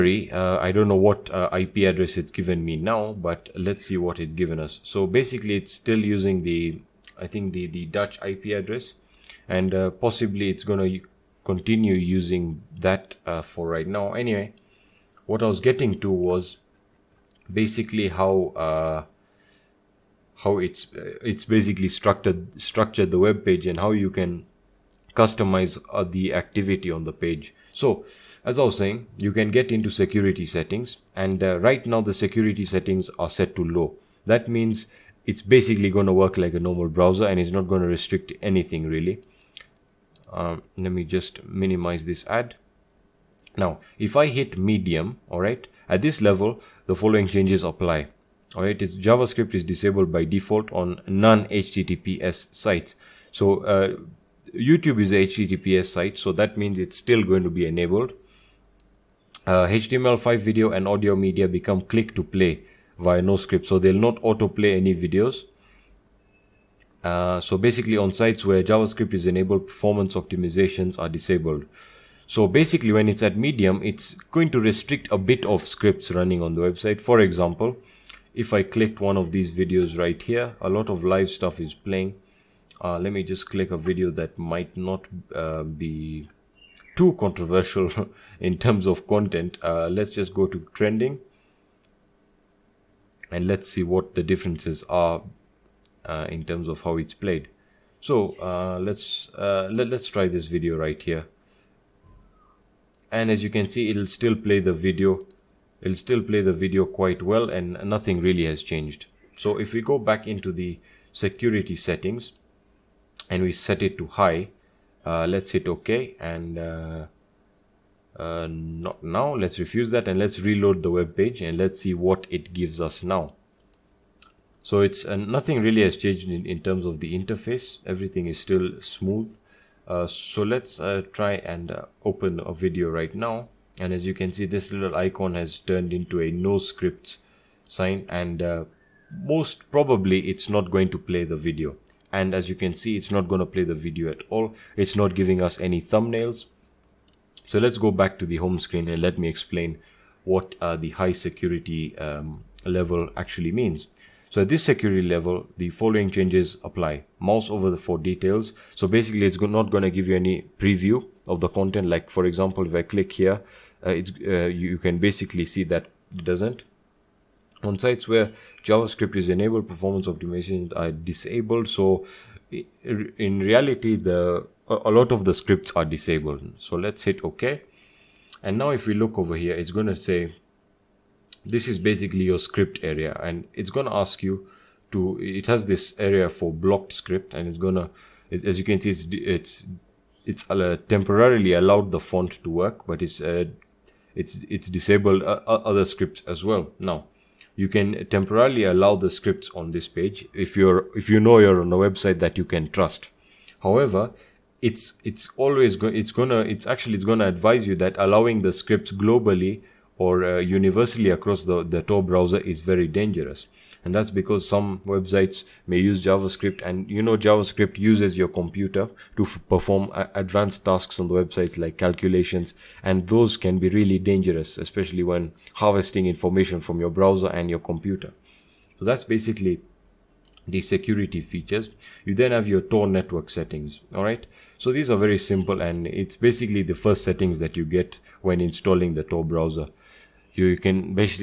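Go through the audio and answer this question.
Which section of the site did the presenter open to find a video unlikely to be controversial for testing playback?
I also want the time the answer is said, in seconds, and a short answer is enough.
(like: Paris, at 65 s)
trending, at 90 s.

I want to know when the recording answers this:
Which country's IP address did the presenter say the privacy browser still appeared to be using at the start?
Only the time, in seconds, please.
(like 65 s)
7 s.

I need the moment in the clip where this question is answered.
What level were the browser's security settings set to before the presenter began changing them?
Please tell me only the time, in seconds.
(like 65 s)
33 s.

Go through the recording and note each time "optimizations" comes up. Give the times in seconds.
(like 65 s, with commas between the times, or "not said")
70 s, 170 s.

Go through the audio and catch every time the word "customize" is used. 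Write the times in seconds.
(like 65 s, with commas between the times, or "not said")
25 s.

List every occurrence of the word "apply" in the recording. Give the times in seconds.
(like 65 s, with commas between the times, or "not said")
47 s, 156 s.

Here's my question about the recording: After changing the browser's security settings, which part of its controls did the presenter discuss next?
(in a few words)
Tor network settings.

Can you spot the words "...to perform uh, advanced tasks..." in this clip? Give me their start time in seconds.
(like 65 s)
219 s.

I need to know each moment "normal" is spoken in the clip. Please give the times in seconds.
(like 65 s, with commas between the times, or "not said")
36 s.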